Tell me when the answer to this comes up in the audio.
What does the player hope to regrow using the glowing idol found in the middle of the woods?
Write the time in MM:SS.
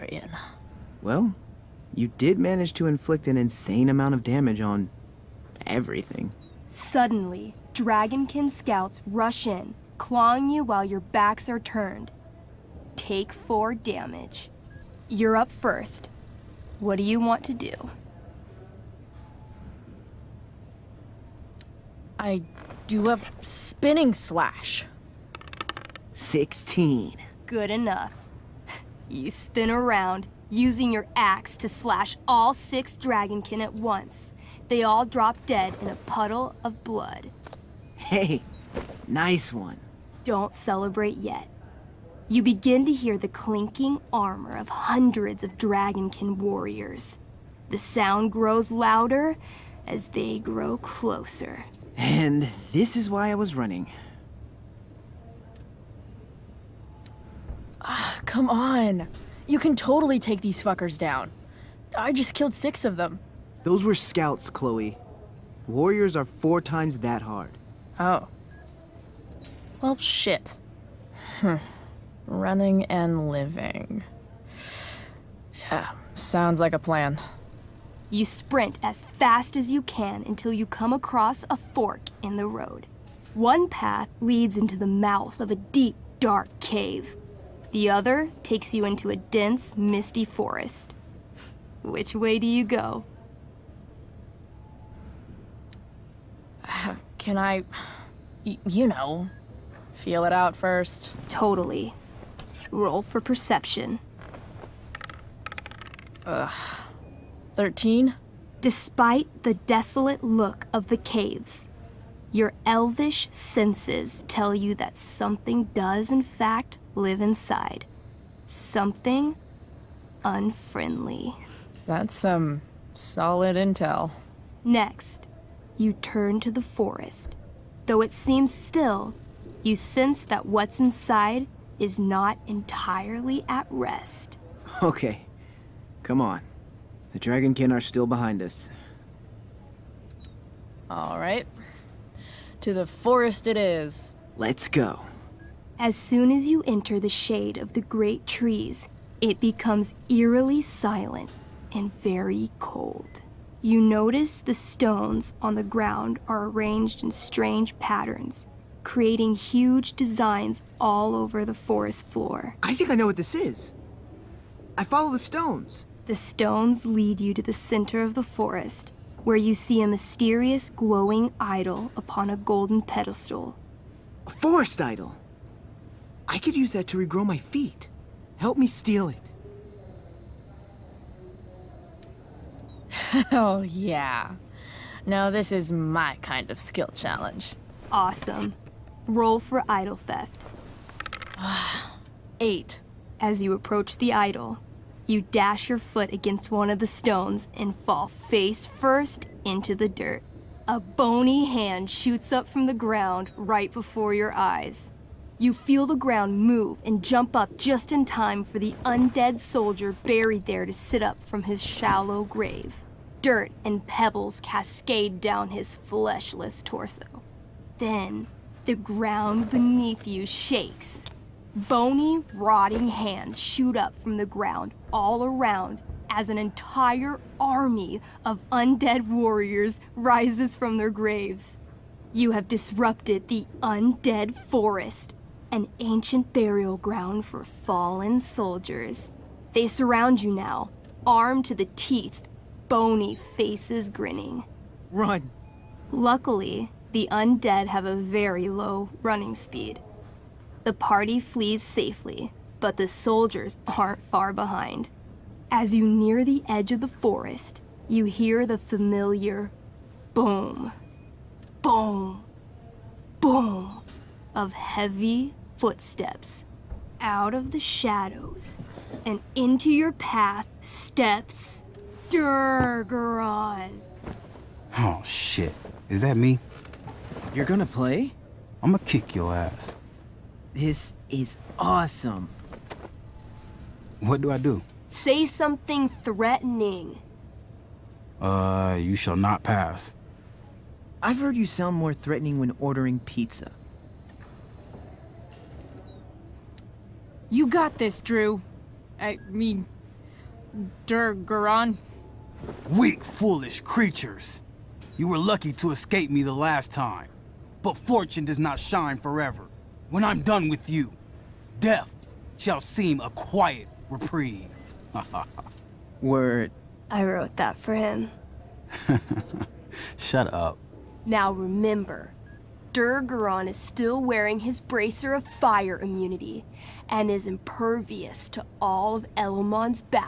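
02:57.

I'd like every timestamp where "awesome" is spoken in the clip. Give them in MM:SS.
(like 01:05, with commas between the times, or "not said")
03:07, 04:41.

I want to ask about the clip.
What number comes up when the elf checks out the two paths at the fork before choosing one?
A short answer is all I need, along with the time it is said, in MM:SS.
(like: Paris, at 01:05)
13, at 01:47.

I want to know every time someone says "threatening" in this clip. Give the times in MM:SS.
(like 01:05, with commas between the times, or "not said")
04:45, 04:51.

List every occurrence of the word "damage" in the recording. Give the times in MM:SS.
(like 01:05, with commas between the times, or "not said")
00:04, 00:13.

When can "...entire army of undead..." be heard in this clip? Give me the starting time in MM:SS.
03:46.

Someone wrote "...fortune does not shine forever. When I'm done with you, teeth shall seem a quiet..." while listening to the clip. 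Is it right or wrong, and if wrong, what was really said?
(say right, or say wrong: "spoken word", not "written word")
wrong: "death", not "teeth".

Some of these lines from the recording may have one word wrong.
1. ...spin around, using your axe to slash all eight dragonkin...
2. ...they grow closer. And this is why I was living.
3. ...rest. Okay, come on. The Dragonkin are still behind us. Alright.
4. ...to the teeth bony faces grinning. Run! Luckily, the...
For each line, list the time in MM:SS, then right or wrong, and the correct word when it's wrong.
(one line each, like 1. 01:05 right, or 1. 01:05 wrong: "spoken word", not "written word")
1. 00:29 wrong: "six", not "eight"
2. 00:50 wrong: "running", not "living"
3. 02:13 right
4. 04:01 right.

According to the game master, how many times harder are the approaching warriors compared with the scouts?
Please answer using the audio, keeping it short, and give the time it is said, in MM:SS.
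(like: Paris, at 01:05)
four times, at 01:06.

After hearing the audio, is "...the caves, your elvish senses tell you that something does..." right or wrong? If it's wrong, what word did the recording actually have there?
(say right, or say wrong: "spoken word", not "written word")
right.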